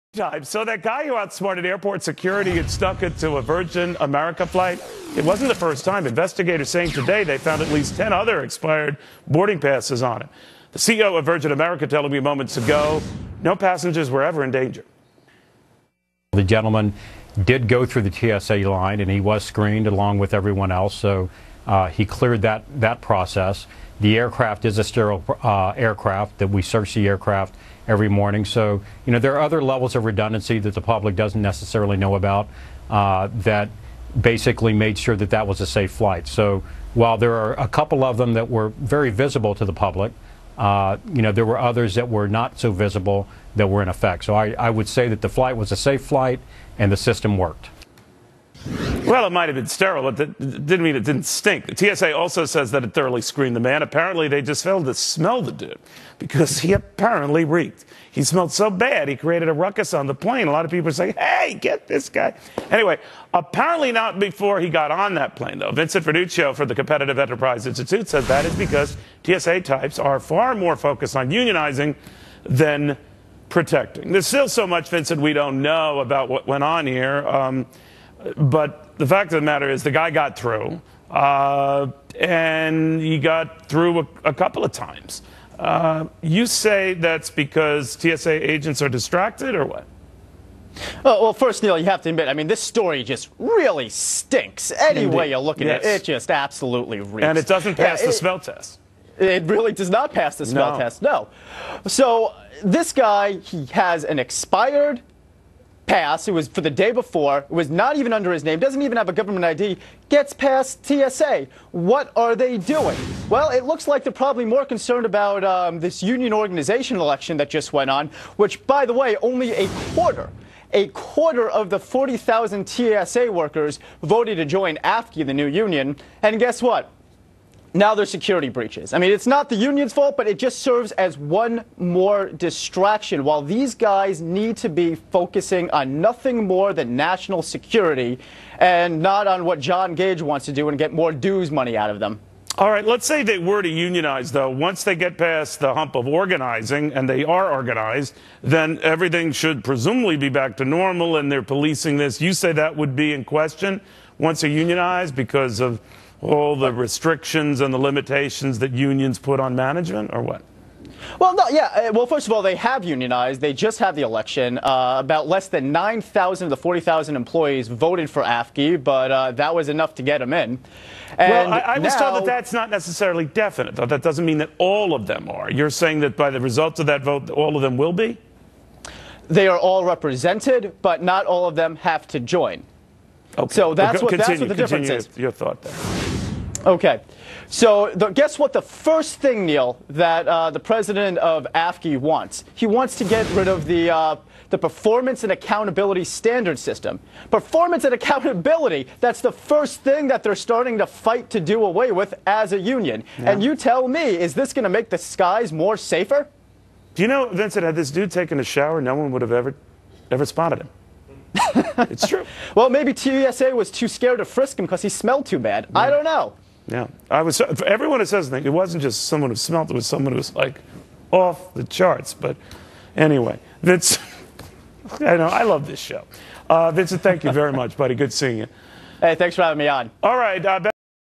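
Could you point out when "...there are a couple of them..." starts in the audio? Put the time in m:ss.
0:37.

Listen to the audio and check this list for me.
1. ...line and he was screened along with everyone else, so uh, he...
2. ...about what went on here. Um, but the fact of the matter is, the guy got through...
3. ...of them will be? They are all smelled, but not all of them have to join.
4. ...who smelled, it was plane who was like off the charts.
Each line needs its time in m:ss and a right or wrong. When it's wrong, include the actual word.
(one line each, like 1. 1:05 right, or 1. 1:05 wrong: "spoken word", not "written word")
1. 0:18 right
2. 1:15 right
3. 2:57 wrong: "represented", not "smelled"
4. 3:39 wrong: "someone", not "plane".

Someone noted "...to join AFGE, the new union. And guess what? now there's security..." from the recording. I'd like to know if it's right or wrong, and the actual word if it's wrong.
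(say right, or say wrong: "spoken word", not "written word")
right.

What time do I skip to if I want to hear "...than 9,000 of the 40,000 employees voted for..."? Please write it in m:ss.
2:45.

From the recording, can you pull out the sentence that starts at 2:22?
All right, let's say they were to unionize, though.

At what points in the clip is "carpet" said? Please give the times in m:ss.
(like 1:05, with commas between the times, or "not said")
not said.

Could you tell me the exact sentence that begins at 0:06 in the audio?
Investigators saying today they found at least 10 other expired boarding passes on it.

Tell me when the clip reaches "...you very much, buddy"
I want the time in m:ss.
3:47.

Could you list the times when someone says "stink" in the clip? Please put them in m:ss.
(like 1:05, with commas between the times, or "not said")
0:51, 1:33.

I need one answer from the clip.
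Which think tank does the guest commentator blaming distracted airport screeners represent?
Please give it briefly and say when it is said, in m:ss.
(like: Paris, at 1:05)
Competitive Enterprise Institute, at 1:06.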